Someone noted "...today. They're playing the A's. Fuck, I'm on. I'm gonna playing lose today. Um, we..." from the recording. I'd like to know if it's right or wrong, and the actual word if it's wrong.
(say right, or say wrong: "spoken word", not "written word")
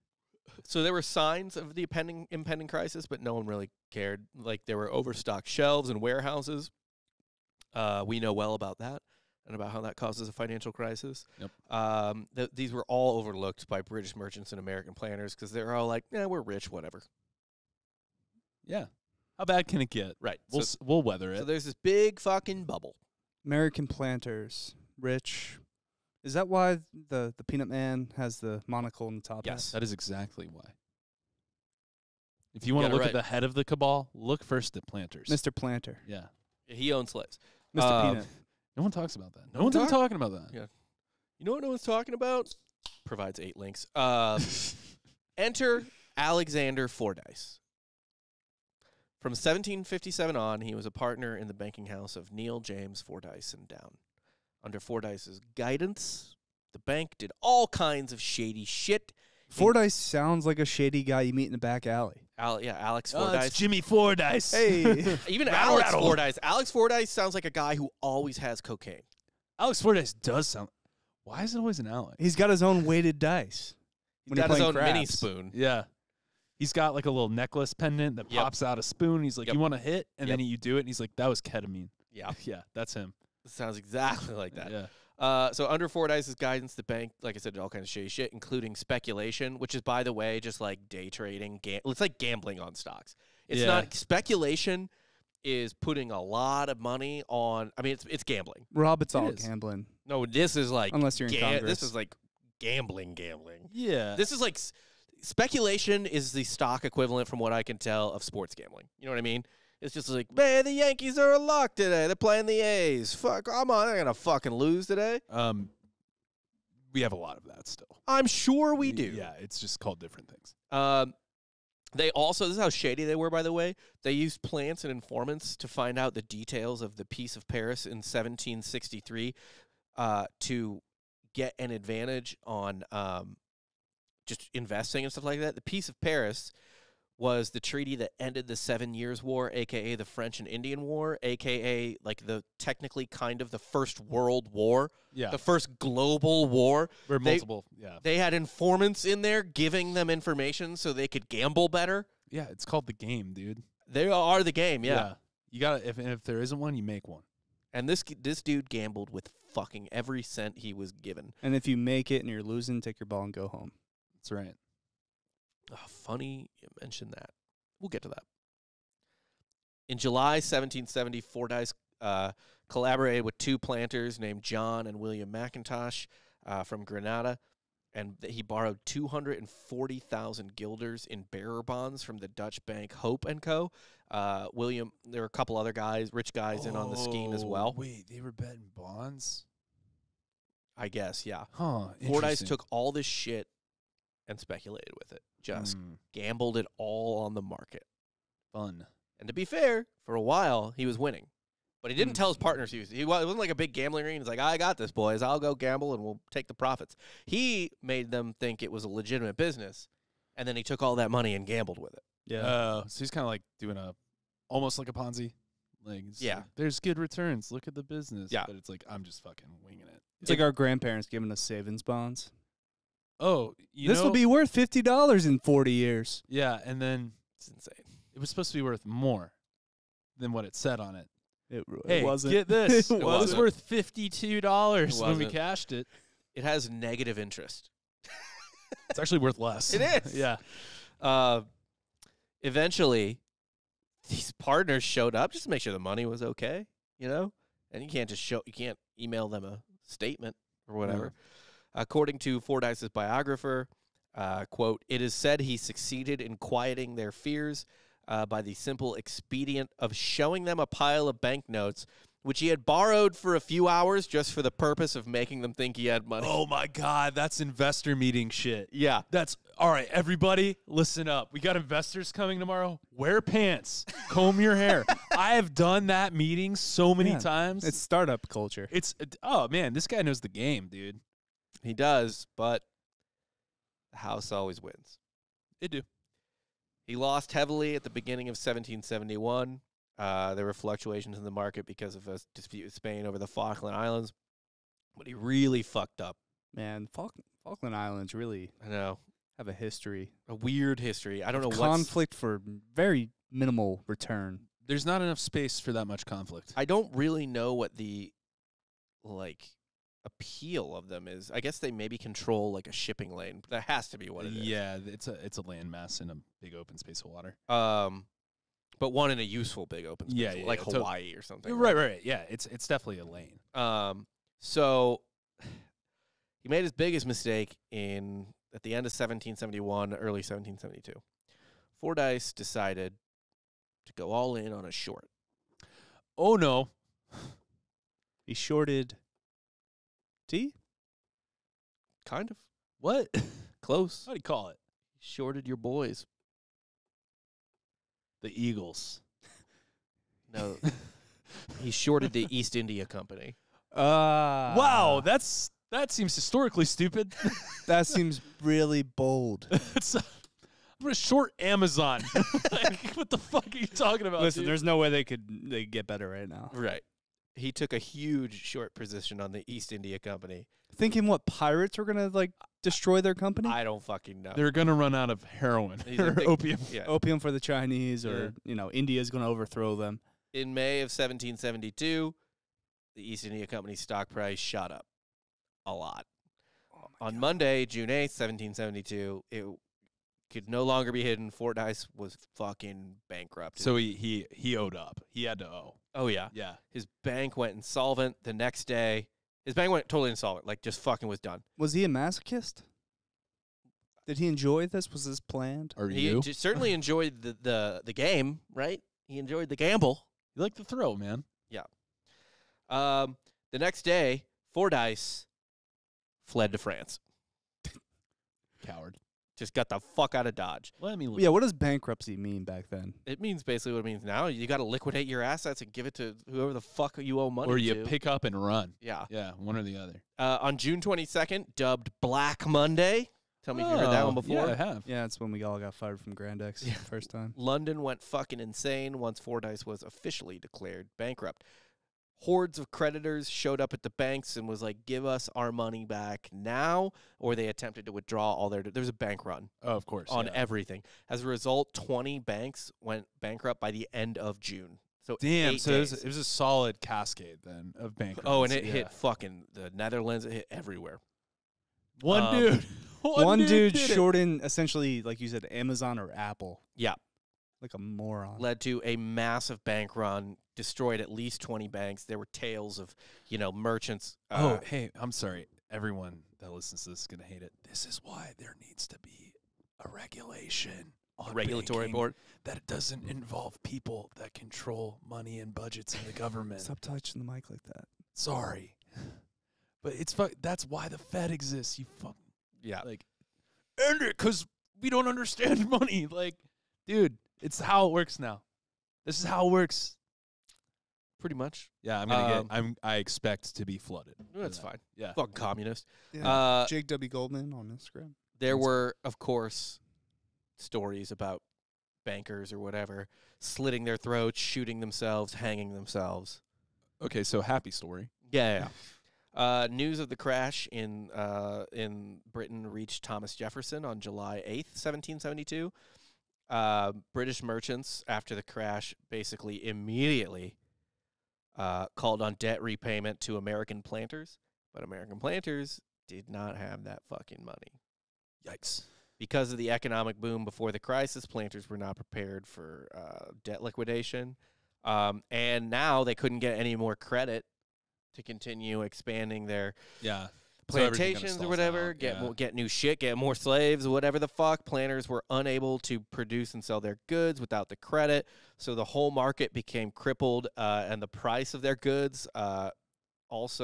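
wrong: "fucking", not "playing".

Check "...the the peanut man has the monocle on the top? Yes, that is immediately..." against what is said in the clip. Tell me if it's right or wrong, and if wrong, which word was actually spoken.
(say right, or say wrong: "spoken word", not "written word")
wrong: "exactly", not "immediately".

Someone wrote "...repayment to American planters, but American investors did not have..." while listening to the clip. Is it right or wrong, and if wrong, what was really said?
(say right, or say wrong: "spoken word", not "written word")
wrong: "planters", not "investors".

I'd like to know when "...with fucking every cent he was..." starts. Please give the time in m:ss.
2:39.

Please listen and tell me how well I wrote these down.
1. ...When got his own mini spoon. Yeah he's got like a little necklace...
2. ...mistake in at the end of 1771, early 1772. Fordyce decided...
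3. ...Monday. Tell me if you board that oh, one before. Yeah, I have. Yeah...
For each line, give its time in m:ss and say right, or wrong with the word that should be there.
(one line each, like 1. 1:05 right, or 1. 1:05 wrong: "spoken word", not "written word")
1. 1:14 right
2. 5:27 right
3. 7:12 wrong: "heard", not "board".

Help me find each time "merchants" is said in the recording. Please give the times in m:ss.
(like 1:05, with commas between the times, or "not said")
0:14, 7:53, 8:47.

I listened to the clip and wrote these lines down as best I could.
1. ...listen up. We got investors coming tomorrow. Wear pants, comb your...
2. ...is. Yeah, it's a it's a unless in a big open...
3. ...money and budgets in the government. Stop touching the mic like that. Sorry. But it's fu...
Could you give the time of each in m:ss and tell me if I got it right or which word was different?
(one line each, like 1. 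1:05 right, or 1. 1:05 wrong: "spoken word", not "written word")
1. 4:30 right
2. 5:14 wrong: "landmass", not "unless"
3. 8:05 right.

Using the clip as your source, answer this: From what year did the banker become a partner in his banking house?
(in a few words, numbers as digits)
1757.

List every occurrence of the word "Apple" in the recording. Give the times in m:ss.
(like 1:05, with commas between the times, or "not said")
7:46.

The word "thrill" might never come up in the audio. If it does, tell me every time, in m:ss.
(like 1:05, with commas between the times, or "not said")
6:50.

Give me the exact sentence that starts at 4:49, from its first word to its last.
Uh, there were fluctuations in the market because of a dispute with Spain over the Falkland Islands, but he really fucked up.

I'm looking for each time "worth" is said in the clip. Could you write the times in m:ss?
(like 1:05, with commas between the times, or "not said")
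3:44, 3:48, 3:53, 3:59.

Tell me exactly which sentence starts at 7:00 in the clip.
Well, I mean, yeah, what does bankruptcy mean back then?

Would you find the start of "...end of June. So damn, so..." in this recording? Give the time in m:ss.
7:33.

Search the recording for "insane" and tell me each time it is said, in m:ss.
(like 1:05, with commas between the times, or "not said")
3:47, 7:18.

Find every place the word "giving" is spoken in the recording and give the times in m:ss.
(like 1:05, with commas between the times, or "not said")
2:29, 3:41.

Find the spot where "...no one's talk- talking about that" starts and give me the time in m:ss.
0:39.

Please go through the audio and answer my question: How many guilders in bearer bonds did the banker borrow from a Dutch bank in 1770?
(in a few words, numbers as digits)
240,000.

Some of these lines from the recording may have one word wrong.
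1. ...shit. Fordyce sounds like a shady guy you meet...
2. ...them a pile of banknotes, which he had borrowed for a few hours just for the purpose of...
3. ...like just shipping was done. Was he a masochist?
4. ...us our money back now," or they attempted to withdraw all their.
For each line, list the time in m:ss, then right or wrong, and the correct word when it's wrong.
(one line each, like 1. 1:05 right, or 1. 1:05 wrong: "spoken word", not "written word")
1. 0:58 right
2. 4:20 right
3. 6:40 wrong: "fucking", not "shipping"
4. 7:25 right.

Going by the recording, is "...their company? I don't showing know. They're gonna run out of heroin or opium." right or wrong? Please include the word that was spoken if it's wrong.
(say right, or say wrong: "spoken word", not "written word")
wrong: "fucking", not "showing".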